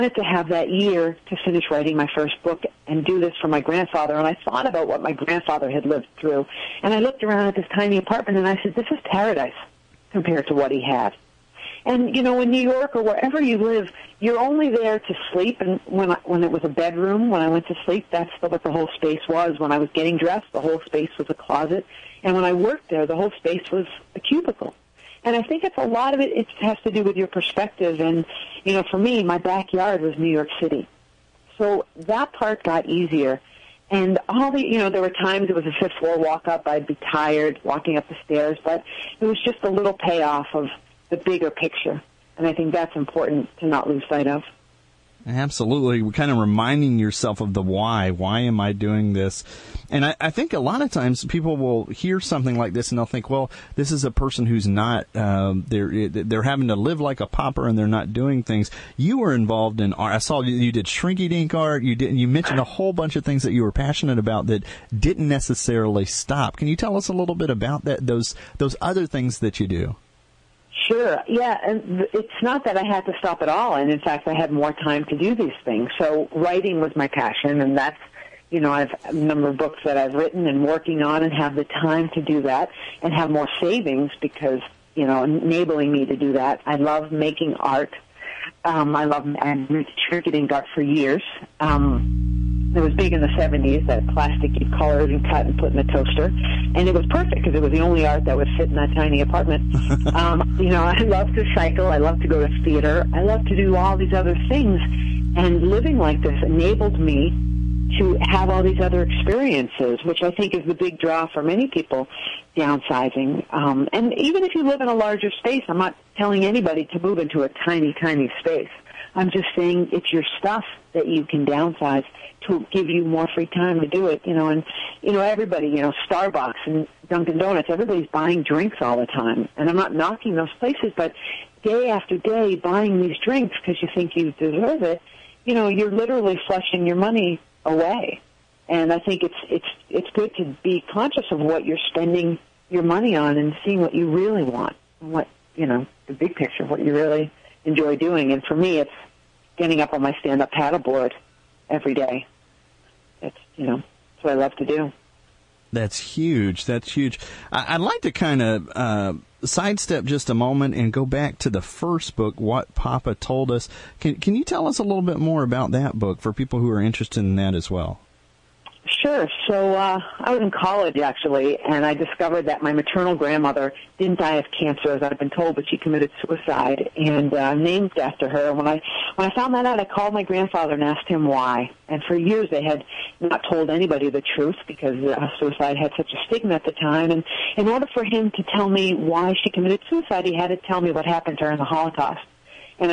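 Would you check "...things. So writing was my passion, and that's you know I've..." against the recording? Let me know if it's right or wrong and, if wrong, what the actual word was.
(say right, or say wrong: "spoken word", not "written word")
right.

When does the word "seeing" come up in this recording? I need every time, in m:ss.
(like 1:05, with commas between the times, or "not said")
2:23.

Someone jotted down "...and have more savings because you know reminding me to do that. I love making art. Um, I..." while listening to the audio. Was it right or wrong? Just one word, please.
wrong.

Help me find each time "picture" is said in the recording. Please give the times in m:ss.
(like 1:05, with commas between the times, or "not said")
0:41, 2:26.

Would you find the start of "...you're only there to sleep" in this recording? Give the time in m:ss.
0:14.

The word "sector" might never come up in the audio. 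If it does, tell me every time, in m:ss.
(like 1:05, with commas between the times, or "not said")
not said.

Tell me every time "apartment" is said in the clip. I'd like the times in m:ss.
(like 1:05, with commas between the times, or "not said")
0:07, 1:39.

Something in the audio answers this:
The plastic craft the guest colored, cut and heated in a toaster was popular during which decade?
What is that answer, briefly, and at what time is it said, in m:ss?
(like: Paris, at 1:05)
1970s, at 1:33.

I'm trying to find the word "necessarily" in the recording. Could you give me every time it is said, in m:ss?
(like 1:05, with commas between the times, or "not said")
1:05.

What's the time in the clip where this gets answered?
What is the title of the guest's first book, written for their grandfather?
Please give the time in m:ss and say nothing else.
2:42.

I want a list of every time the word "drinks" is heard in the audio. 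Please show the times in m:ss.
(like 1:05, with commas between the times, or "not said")
2:08, 2:13.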